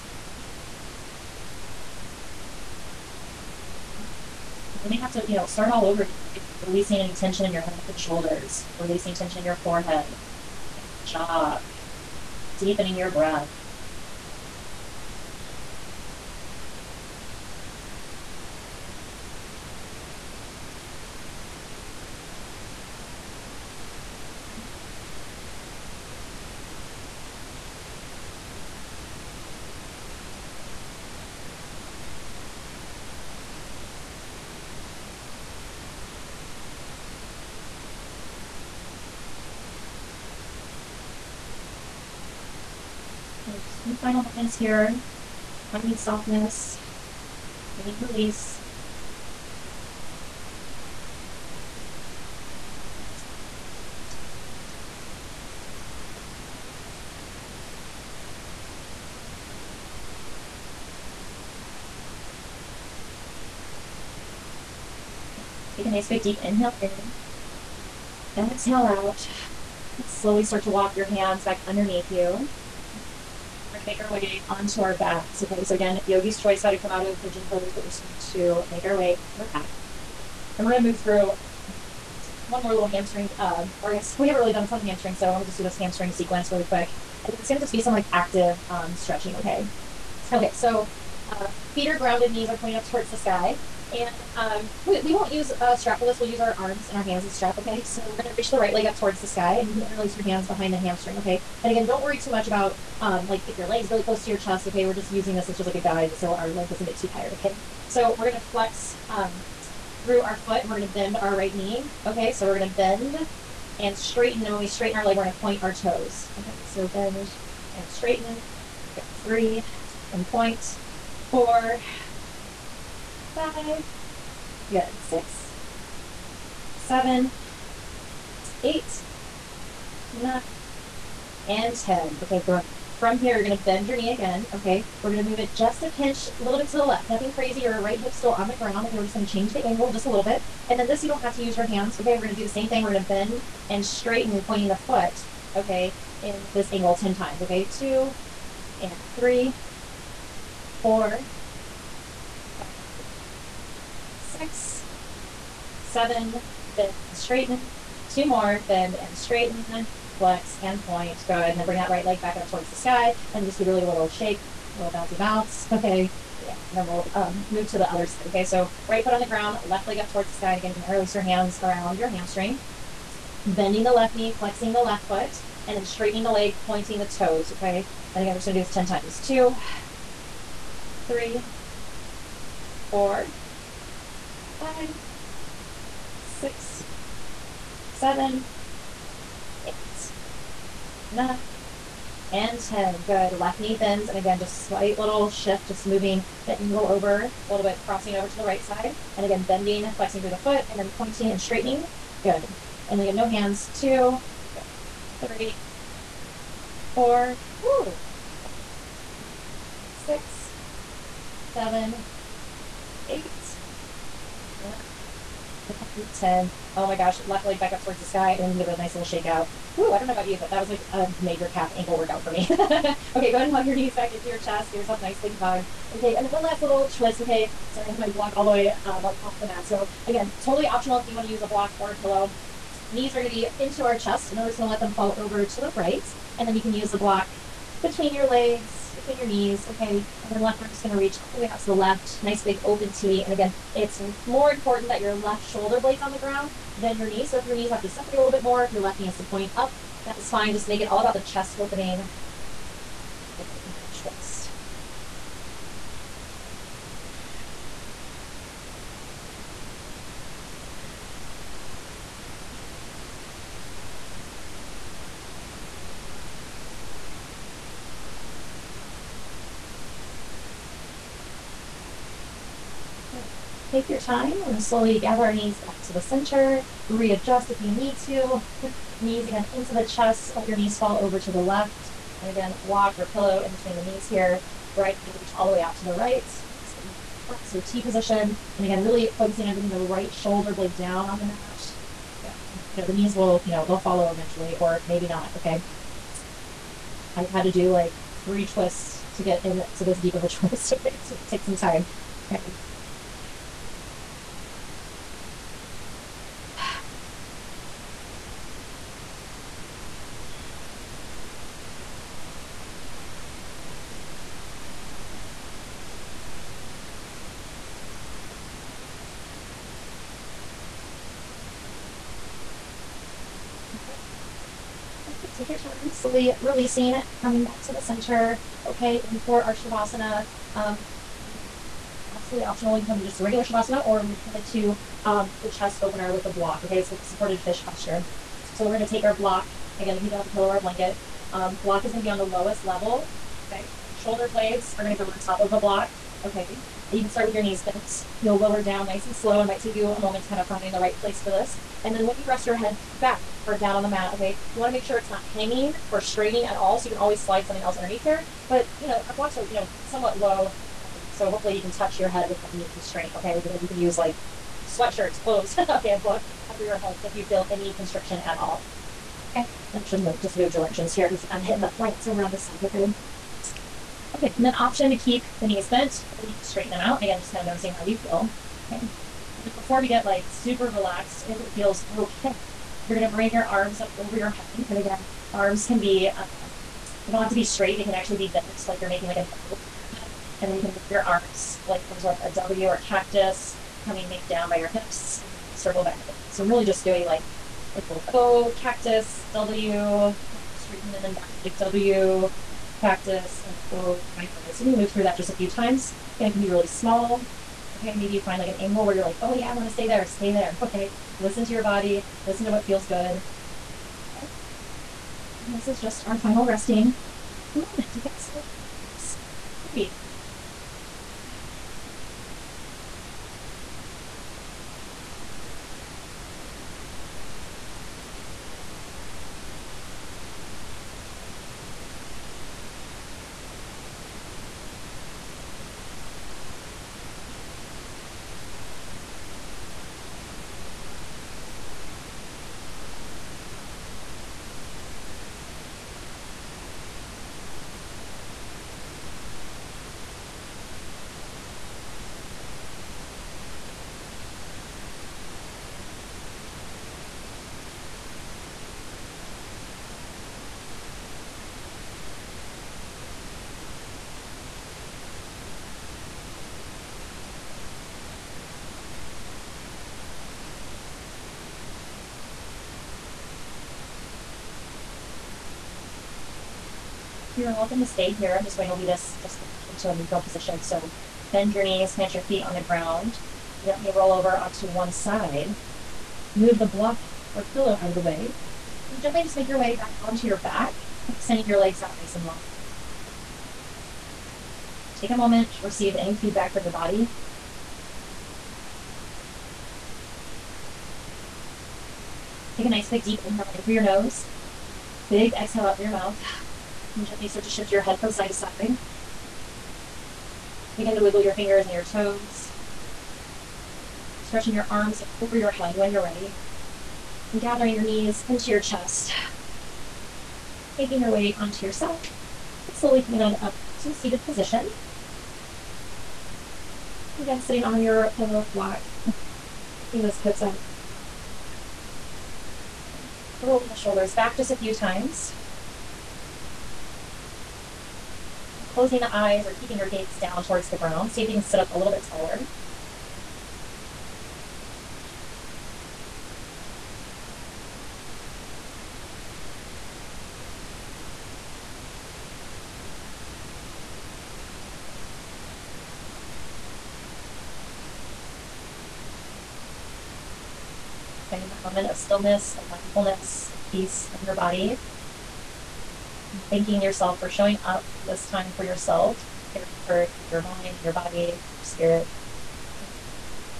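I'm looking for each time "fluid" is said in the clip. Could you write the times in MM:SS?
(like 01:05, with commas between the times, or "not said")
not said.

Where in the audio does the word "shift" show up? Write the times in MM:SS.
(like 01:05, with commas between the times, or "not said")
03:15, 08:27.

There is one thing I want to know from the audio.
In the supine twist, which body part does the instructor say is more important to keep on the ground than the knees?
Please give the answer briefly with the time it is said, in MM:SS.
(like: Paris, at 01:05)
Left shoulder blade, at 04:05.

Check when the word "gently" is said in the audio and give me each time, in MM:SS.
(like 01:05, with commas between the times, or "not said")
08:03, 08:09, 08:27.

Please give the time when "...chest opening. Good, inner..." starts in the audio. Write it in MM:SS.
04:11.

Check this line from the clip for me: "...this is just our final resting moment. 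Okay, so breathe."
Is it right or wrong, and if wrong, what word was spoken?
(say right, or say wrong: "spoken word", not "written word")
right.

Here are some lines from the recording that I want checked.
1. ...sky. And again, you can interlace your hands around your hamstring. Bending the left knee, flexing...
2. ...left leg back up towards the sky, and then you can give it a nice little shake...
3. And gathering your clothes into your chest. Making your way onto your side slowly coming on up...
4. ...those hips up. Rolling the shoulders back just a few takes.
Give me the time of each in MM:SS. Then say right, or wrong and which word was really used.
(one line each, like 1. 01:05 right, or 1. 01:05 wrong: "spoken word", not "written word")
1. 02:50 right
2. 03:37 right
3. 08:37 wrong: "knees", not "clothes"
4. 08:50 wrong: "times", not "takes".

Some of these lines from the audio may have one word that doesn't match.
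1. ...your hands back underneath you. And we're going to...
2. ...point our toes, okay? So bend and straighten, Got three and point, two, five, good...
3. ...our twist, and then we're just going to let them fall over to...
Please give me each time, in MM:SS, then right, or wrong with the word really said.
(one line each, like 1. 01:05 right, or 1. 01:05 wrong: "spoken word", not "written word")
1. 01:10 right
2. 01:55 wrong: "four", not "two"
3. 03:53 wrong: "chest", not "twist".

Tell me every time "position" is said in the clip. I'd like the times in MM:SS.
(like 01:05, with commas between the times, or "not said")
04:47, 08:00, 08:44.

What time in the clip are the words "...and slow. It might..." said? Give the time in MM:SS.
05:49.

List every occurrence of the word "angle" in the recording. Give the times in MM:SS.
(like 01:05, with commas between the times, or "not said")
02:19, 02:26, 03:16, 06:48.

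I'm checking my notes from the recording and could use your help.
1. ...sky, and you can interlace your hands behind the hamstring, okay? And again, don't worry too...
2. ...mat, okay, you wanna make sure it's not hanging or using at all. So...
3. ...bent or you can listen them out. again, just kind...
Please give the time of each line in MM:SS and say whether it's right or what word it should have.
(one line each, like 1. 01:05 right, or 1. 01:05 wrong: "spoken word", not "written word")
1. 01:39 right
2. 05:53 wrong: "straining", not "using"
3. 06:15 wrong: "straighten", not "listen".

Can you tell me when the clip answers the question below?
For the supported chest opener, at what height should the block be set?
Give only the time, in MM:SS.
05:42.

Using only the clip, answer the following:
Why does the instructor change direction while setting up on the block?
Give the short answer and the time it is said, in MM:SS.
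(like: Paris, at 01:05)
Hitting the plants, at 06:11.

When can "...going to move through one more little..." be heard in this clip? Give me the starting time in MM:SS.
01:20.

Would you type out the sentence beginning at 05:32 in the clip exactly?
You can come in just a regular Shavasana or we come into um, the chest opener with the block.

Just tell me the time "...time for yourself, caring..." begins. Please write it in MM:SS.
09:28.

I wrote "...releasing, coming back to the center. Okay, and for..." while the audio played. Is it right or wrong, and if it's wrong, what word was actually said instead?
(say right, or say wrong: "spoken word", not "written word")
right.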